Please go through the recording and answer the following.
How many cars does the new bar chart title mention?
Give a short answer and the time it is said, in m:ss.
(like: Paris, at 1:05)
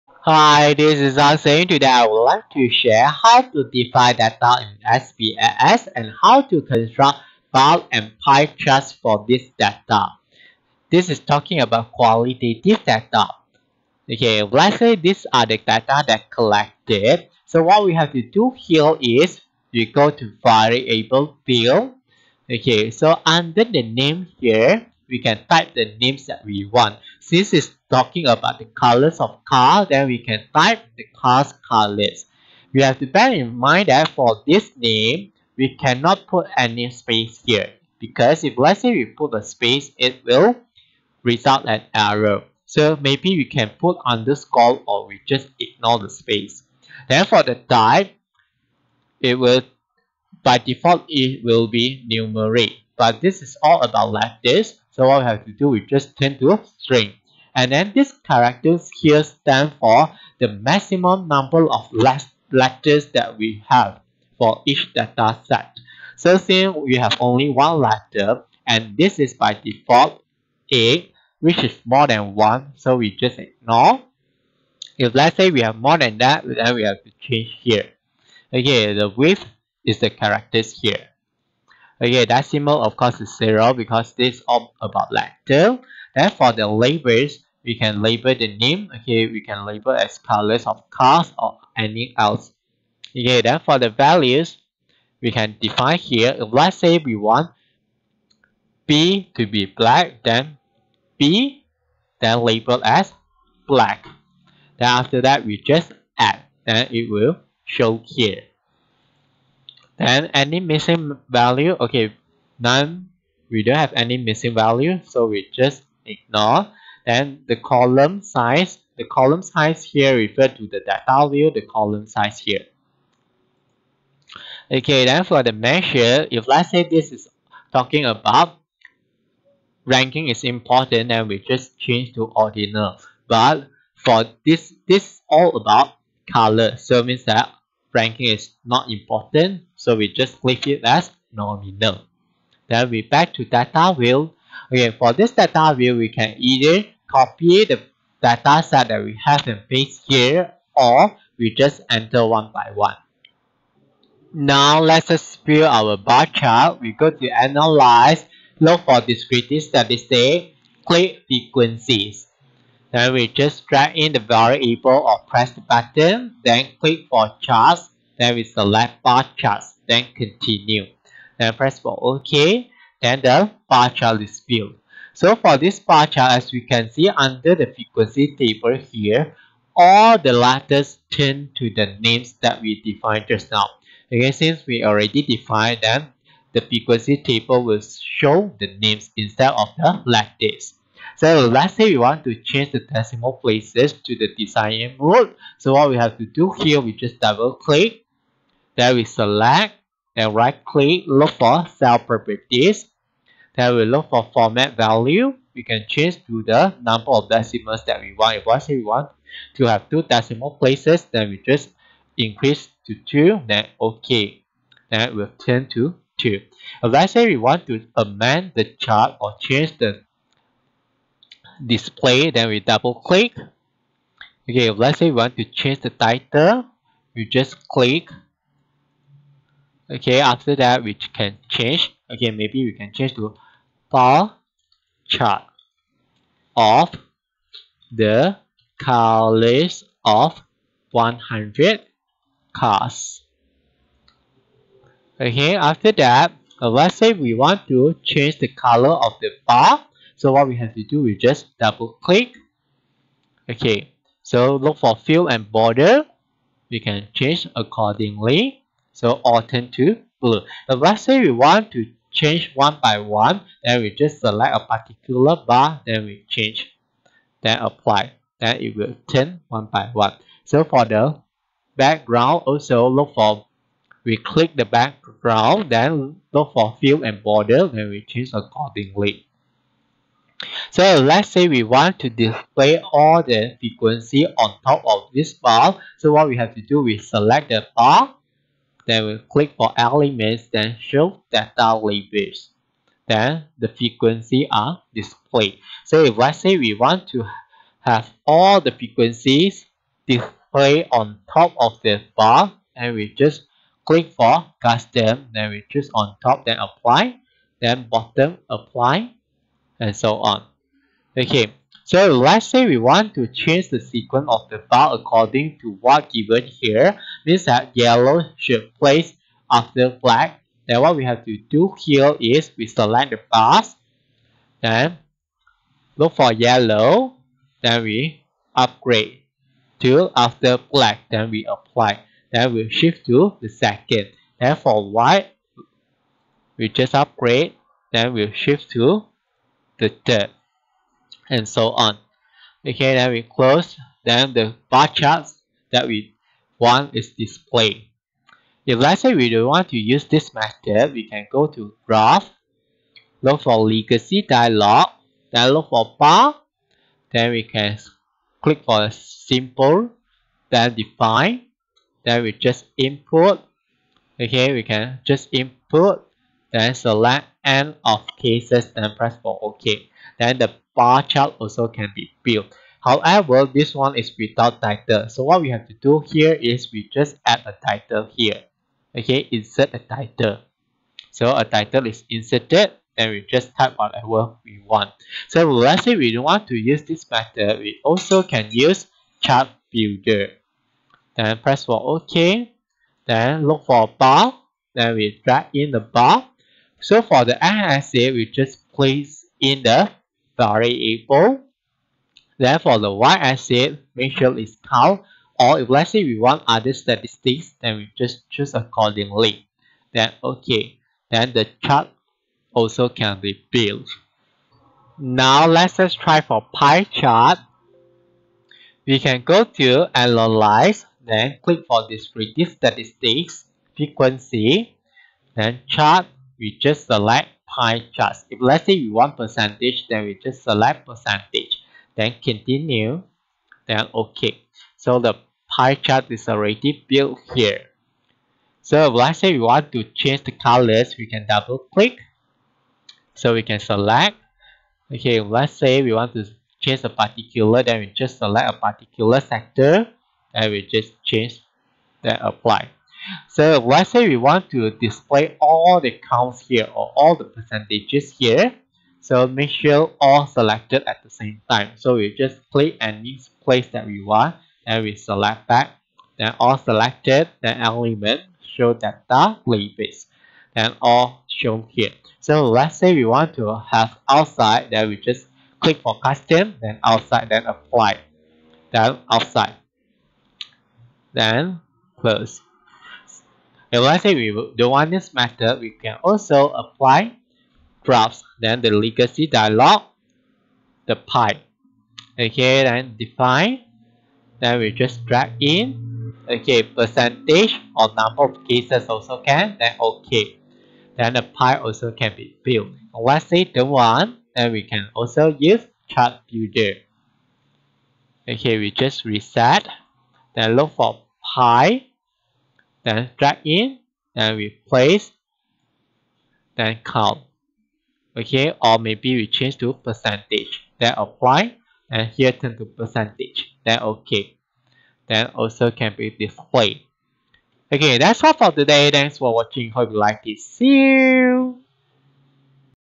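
100, at 4:00.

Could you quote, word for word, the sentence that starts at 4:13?
Okay, so look for fill and border.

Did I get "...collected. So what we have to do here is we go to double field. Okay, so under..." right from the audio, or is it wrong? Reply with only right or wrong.
wrong.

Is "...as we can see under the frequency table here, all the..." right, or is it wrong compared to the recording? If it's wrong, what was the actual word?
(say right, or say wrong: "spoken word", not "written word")
right.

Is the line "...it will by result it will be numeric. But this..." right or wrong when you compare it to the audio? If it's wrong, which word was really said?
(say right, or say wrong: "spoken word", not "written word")
wrong: "default", not "result".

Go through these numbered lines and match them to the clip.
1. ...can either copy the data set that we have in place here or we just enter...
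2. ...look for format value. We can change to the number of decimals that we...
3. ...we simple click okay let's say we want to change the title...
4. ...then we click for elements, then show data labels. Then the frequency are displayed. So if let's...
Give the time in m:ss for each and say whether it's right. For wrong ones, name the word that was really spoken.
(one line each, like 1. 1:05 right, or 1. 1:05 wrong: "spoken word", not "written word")
1. 2:26 right
2. 3:23 right
3. 3:42 wrong: "double", not "simple"
4. 4:48 right.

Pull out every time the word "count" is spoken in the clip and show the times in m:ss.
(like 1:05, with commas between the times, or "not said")
6:44, 7:36, 8:36.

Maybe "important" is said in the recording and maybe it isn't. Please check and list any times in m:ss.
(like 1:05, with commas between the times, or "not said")
2:10, 2:18.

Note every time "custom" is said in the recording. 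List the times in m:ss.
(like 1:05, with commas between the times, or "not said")
5:04, 7:55.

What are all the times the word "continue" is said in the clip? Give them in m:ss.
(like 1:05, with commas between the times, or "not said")
2:50, 7:12.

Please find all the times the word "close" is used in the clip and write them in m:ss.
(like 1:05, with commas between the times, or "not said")
5:43, 8:01.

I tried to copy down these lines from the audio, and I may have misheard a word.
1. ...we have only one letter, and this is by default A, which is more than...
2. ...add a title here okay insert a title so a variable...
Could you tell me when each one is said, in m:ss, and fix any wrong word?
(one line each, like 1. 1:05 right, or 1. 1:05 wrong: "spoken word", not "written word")
1. 1:06 right
2. 6:17 wrong: "title", not "variable".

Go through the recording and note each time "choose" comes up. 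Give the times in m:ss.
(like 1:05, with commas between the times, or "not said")
5:05, 6:48.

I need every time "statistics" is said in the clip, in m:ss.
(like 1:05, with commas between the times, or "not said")
2:39, 6:46, 7:02.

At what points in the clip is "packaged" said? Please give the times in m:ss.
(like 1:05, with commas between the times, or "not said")
not said.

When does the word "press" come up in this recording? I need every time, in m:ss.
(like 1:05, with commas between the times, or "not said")
2:45, 2:51, 6:08, 6:31.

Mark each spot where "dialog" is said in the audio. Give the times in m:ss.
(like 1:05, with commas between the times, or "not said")
5:54, 8:09.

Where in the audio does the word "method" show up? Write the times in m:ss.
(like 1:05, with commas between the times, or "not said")
5:50, 6:27, 8:05.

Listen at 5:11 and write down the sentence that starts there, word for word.
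Okay, so let's say we want to change the sequence of the file according to what given here.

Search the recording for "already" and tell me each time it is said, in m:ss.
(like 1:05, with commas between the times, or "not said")
3:04, 7:16.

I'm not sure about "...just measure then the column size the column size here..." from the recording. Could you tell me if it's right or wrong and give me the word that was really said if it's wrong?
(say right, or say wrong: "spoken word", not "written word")
wrong: "ignore", not "measure".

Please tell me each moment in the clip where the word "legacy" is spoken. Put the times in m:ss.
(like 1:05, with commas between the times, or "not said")
5:53, 8:08.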